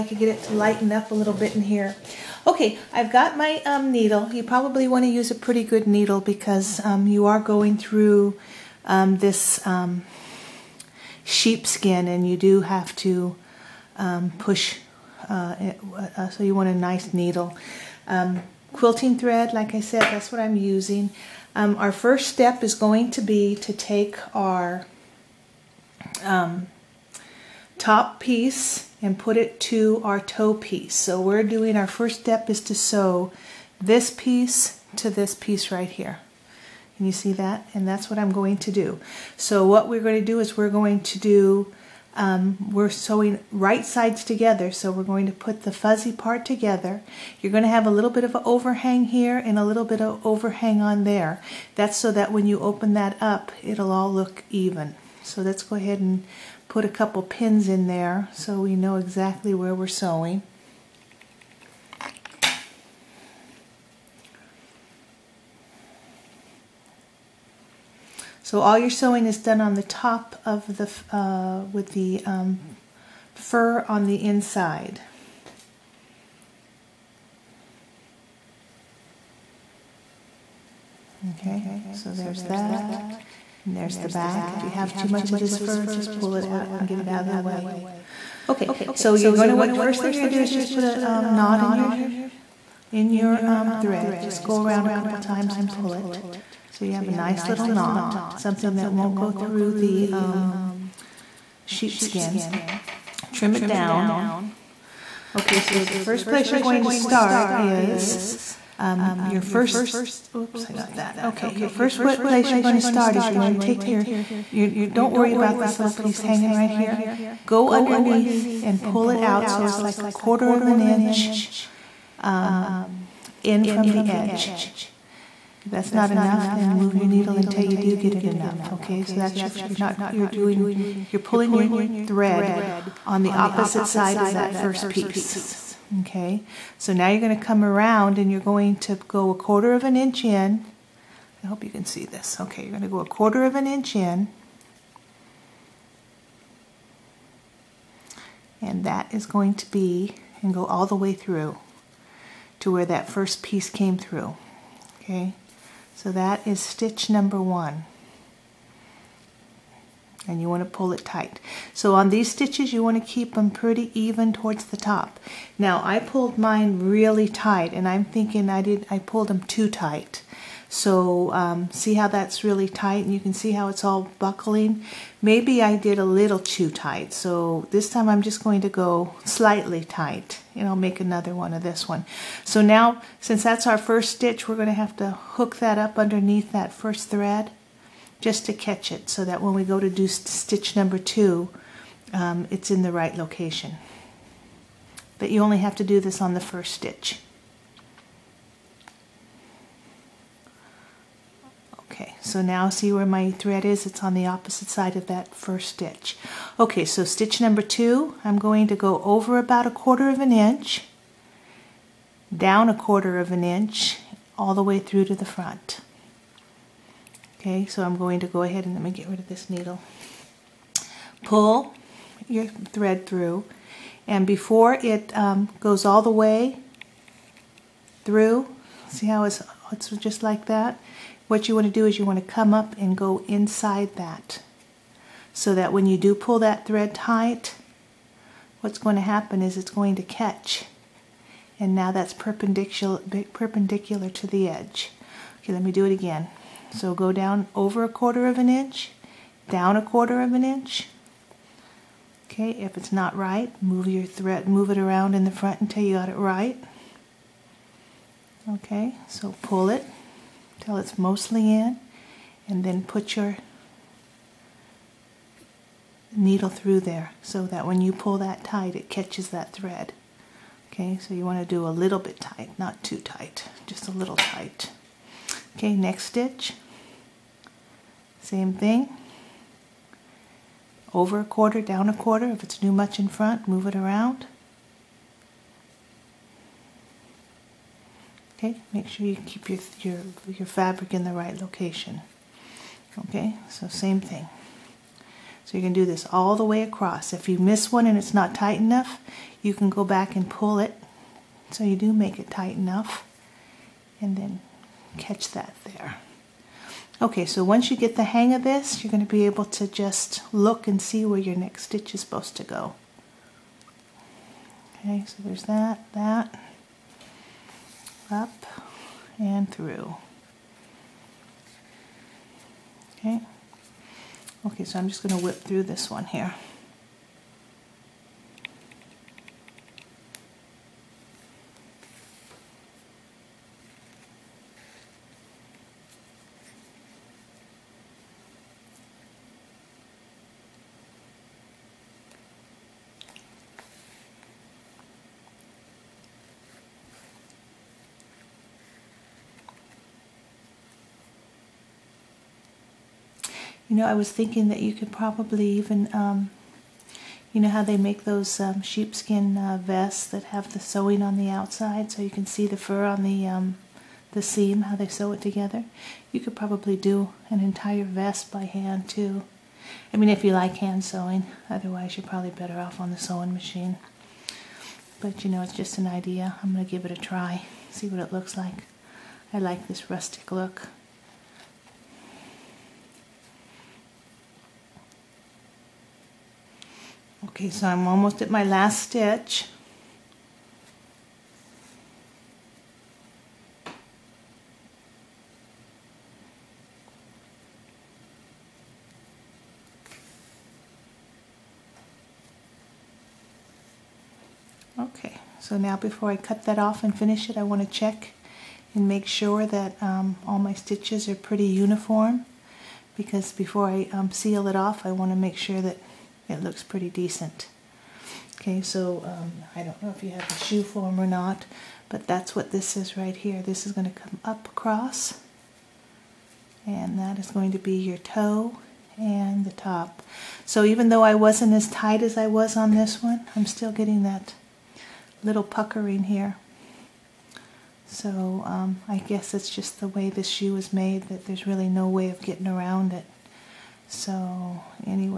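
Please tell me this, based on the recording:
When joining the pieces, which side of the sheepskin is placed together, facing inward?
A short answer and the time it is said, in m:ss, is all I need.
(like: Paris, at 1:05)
The fuzzy part, at 0:45.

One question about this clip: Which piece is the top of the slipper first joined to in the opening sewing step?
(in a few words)
Toe piece.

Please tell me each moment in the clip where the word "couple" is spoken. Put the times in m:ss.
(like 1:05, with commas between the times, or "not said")
0:56, 1:34.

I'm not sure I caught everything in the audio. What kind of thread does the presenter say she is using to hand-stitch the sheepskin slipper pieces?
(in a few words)
Quilting thread.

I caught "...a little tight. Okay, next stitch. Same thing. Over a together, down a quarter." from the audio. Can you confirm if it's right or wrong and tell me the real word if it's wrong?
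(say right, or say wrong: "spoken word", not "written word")
wrong: "quarter", not "together".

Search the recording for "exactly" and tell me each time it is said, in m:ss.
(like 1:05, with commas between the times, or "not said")
0:58.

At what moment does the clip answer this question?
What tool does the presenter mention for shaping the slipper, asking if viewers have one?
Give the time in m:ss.
7:00.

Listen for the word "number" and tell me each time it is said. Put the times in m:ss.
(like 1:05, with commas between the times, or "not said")
2:37, 3:10, 3:27.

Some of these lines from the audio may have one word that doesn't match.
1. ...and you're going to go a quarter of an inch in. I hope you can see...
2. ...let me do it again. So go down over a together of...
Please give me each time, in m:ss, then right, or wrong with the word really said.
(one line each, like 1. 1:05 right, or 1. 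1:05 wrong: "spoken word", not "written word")
1. 2:18 right
2. 4:05 wrong: "quarter", not "together".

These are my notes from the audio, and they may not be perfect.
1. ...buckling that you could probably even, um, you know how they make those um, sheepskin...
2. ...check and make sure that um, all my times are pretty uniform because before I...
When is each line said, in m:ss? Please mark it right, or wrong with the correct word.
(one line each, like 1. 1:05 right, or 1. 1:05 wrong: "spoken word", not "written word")
1. 5:54 wrong: "thinking", not "buckling"
2. 6:47 wrong: "stitches", not "times".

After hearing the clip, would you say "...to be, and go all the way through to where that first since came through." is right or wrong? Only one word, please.
wrong.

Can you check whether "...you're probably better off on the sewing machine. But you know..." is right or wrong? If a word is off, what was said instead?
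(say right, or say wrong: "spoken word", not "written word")
right.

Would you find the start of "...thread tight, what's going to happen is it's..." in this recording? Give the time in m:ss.
3:56.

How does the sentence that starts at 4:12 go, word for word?
Okay, if it's not right, move your thread, move it around in the front until you got it right.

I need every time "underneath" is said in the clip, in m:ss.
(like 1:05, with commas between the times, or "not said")
1:57, 3:05.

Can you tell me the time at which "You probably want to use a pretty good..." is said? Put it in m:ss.
0:04.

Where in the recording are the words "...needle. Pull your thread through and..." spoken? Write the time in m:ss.
3:39.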